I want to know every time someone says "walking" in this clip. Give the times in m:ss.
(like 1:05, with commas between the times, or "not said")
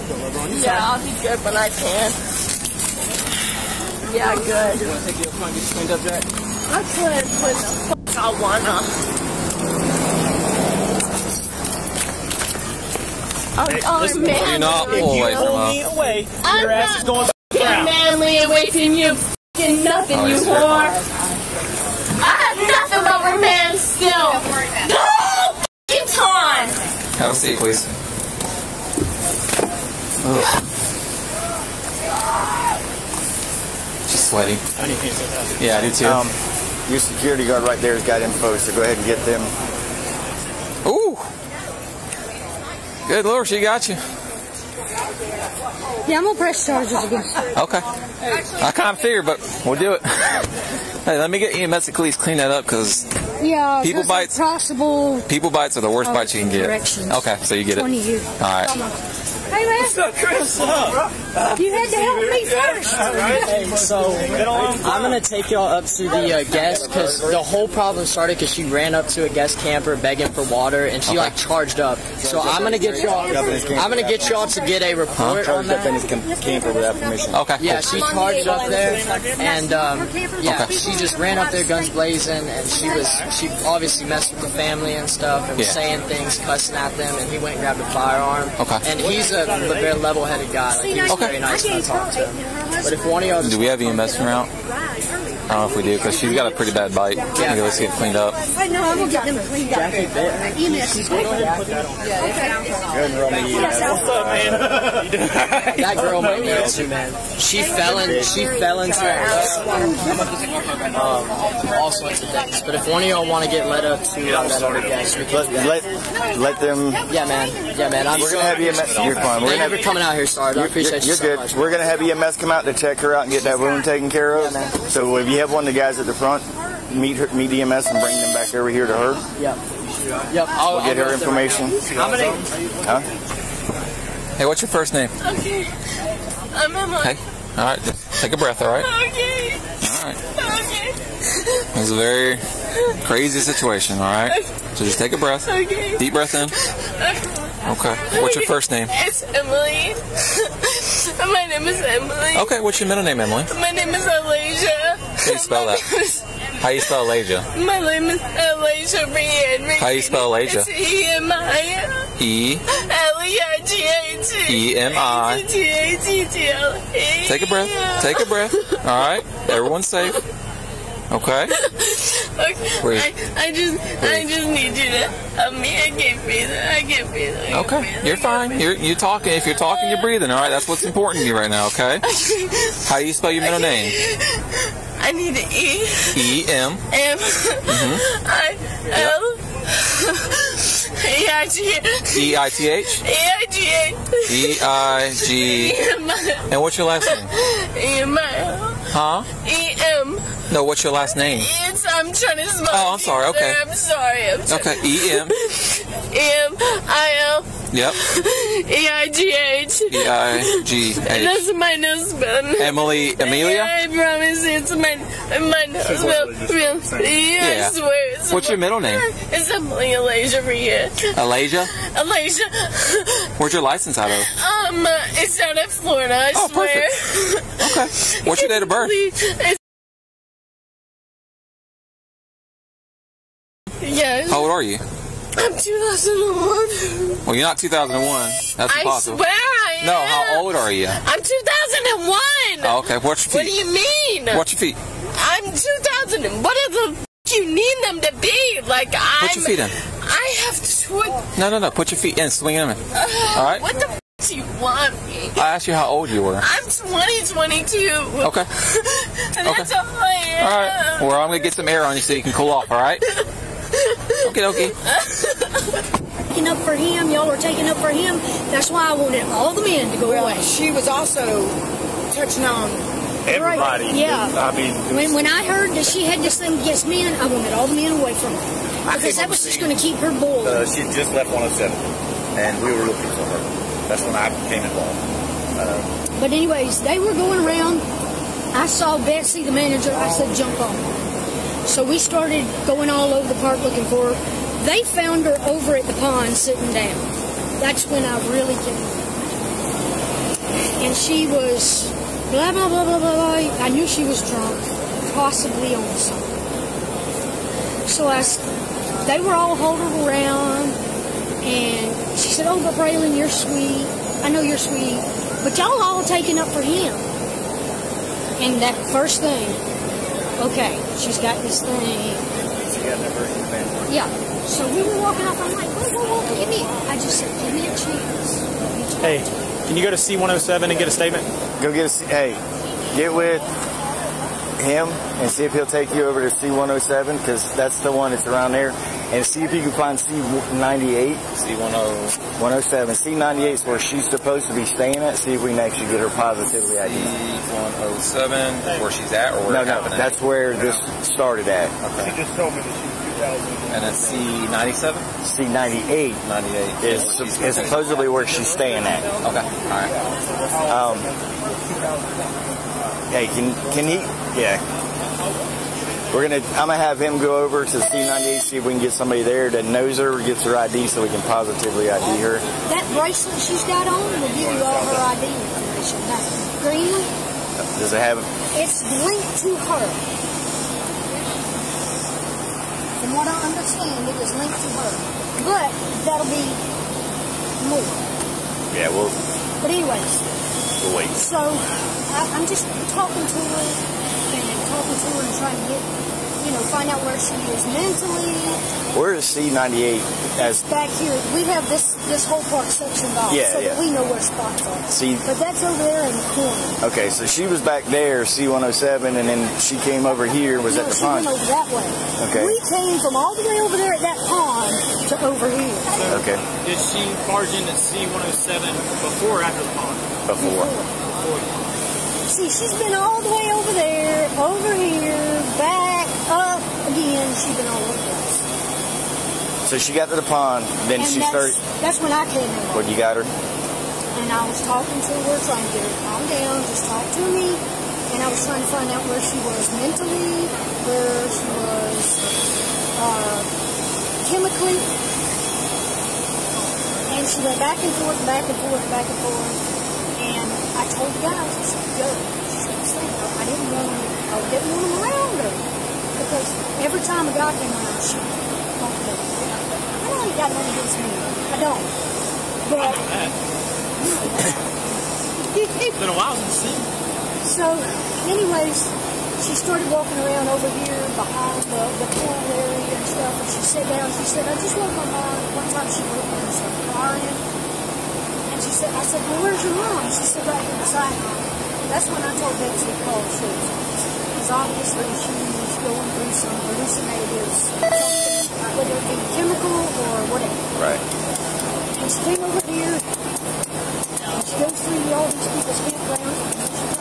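5:25, 7:49.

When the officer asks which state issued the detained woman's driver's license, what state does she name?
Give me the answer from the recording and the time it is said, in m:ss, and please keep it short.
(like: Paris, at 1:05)
Florida, at 3:45.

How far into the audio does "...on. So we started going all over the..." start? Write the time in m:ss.
4:50.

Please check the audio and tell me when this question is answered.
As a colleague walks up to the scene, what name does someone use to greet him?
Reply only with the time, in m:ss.
1:00.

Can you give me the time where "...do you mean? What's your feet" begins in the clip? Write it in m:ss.
4:03.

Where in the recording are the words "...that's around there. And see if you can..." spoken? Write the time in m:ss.
5:38.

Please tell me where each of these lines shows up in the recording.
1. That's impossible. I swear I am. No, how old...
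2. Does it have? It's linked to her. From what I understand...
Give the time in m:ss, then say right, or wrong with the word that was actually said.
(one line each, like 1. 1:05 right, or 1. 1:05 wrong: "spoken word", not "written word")
1. 3:58 right
2. 6:17 right.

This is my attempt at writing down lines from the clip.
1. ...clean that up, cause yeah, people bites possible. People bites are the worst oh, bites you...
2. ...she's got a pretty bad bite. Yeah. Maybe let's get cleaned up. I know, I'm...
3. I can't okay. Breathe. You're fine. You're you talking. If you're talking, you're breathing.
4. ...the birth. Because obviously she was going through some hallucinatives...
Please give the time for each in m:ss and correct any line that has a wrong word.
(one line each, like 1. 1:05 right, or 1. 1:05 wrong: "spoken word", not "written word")
1. 0:52 right
2. 1:36 right
3. 2:57 right
4. 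8:03 wrong: "truth", not "birth".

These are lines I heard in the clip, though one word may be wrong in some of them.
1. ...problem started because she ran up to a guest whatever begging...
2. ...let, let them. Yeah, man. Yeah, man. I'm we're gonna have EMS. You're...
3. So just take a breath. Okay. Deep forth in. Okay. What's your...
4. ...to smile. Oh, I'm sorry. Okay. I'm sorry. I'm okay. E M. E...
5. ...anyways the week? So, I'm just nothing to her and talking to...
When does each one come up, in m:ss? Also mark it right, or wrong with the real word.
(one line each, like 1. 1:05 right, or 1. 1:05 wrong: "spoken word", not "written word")
1. 1:07 wrong: "camper", not "whatever"
2. 1:55 right
3. 2:24 wrong: "breath", not "forth"
4. 3:22 right
5. 6:29 wrong: "talking", not "nothing".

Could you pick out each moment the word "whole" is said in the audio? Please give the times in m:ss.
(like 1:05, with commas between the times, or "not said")
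1:07, 6:42.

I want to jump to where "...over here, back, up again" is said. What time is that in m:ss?
7:04.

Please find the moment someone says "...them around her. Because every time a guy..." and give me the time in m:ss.
7:34.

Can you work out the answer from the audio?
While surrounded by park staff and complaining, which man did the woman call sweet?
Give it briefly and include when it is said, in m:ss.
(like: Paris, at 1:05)
Braylon, at 5:12.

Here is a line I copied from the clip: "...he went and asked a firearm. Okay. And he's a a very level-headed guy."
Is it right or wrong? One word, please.
wrong.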